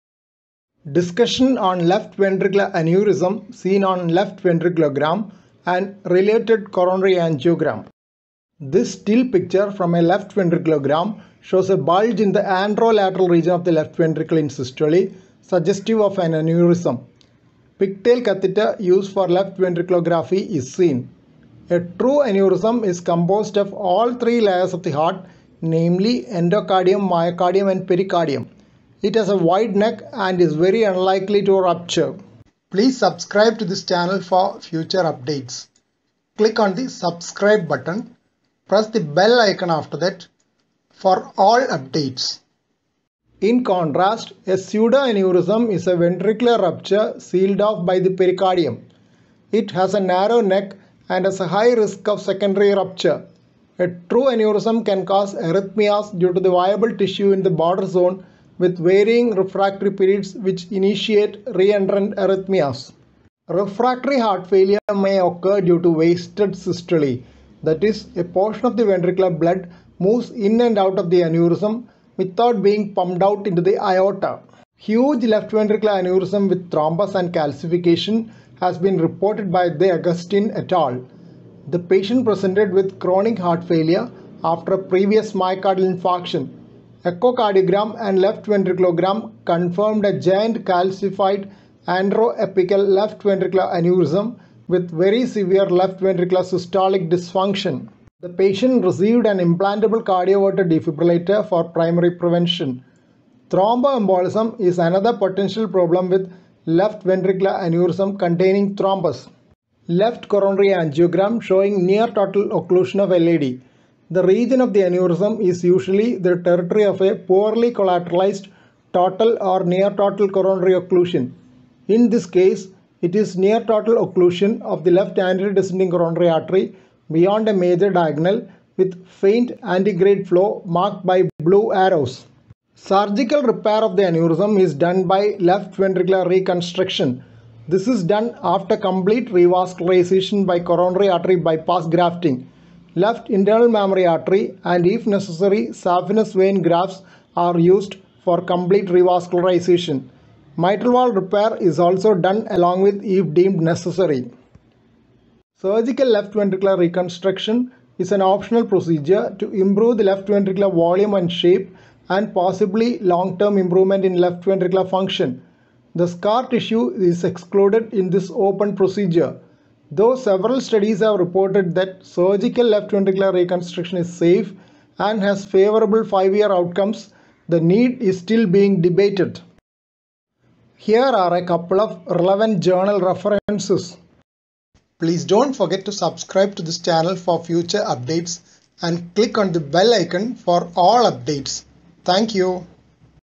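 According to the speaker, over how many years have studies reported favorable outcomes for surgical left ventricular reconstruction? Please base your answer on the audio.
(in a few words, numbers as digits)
5.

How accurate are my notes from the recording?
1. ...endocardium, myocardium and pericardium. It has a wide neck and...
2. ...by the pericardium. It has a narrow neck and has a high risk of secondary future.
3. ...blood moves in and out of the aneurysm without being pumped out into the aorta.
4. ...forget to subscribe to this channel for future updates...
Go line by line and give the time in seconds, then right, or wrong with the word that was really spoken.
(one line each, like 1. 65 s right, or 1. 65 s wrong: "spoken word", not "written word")
1. 26 s right
2. 47 s wrong: "rupture", not "future"
3. 69 s right
4. 185 s right.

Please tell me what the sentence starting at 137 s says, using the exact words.
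This is done after complete revascularization by coronary artery bypass grafting.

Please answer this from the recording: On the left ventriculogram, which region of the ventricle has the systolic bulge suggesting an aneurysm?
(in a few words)
anterolateral.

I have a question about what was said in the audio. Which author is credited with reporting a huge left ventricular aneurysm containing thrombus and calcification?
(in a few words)
De Agustin.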